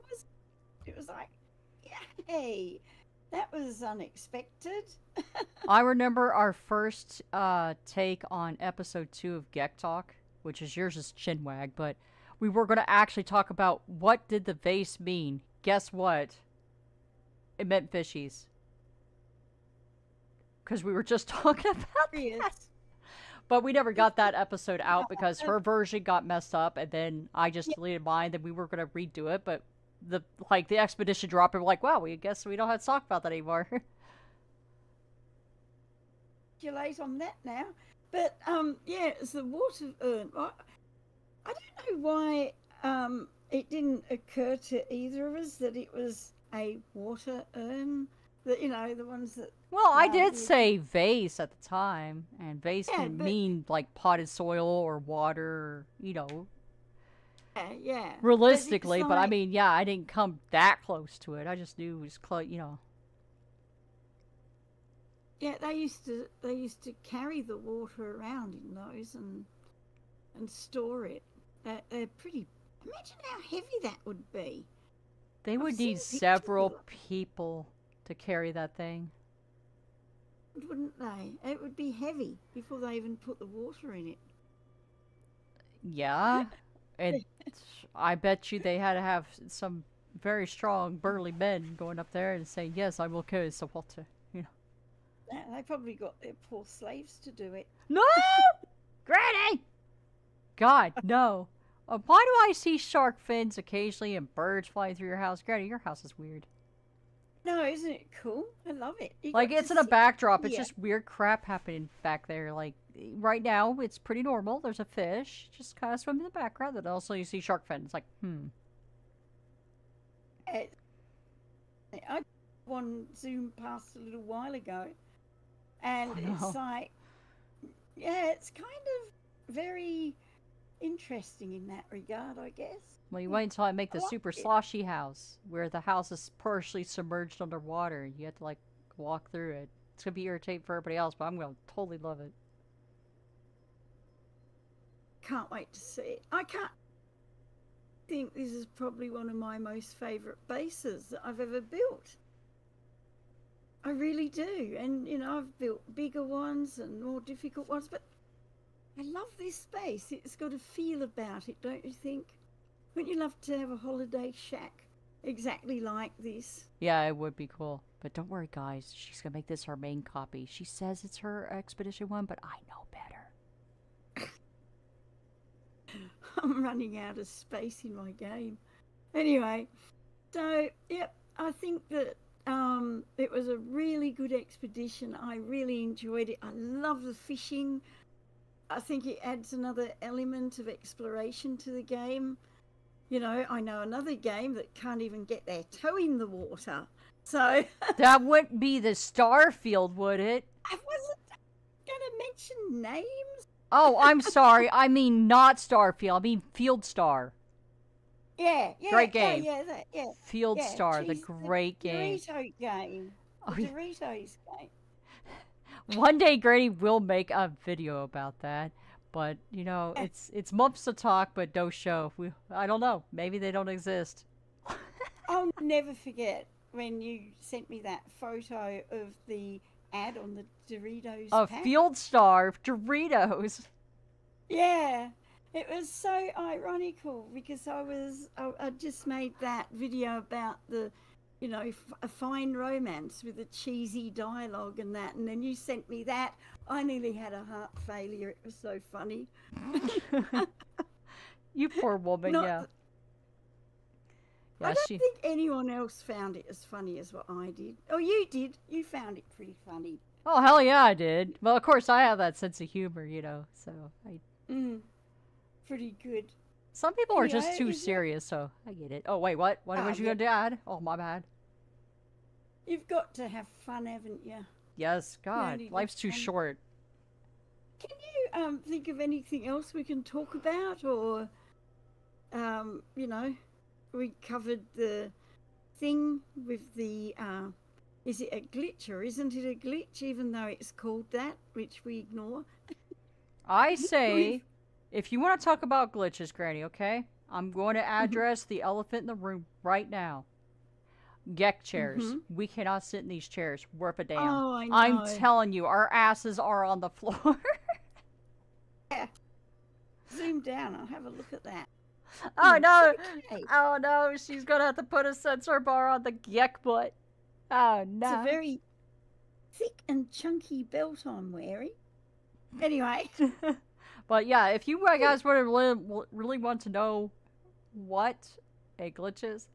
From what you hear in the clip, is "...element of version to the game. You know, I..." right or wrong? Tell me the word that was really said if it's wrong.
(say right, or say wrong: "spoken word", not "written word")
wrong: "exploration", not "version".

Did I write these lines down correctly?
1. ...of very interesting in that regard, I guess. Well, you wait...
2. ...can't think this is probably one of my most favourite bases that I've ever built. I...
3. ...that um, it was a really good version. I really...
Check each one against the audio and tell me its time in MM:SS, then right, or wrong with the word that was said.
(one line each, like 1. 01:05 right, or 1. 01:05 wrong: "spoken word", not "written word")
1. 02:08 right
2. 02:26 right
3. 03:01 wrong: "expedition", not "version".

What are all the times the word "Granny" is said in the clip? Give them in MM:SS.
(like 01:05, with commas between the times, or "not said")
01:39, 01:45, 04:56.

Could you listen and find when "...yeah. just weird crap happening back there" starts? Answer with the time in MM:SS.
01:50.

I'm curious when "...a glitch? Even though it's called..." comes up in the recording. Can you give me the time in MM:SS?
04:49.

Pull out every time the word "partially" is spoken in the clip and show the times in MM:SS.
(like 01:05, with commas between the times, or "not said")
02:16.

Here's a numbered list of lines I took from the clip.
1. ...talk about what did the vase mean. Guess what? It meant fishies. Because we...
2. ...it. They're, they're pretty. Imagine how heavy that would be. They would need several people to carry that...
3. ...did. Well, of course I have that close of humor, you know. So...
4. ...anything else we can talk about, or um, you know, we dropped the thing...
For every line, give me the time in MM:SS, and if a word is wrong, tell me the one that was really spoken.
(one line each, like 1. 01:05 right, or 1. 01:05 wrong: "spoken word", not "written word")
1. 00:13 right
2. 01:11 right
3. 04:20 wrong: "sense", not "close"
4. 04:38 wrong: "covered", not "dropped".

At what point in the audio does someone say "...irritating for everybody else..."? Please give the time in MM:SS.
02:20.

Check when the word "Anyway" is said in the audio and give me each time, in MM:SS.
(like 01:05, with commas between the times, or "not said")
02:59, 05:22.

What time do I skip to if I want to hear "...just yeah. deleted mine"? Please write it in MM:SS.
00:27.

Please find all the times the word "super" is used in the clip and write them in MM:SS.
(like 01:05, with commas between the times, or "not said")
02:14.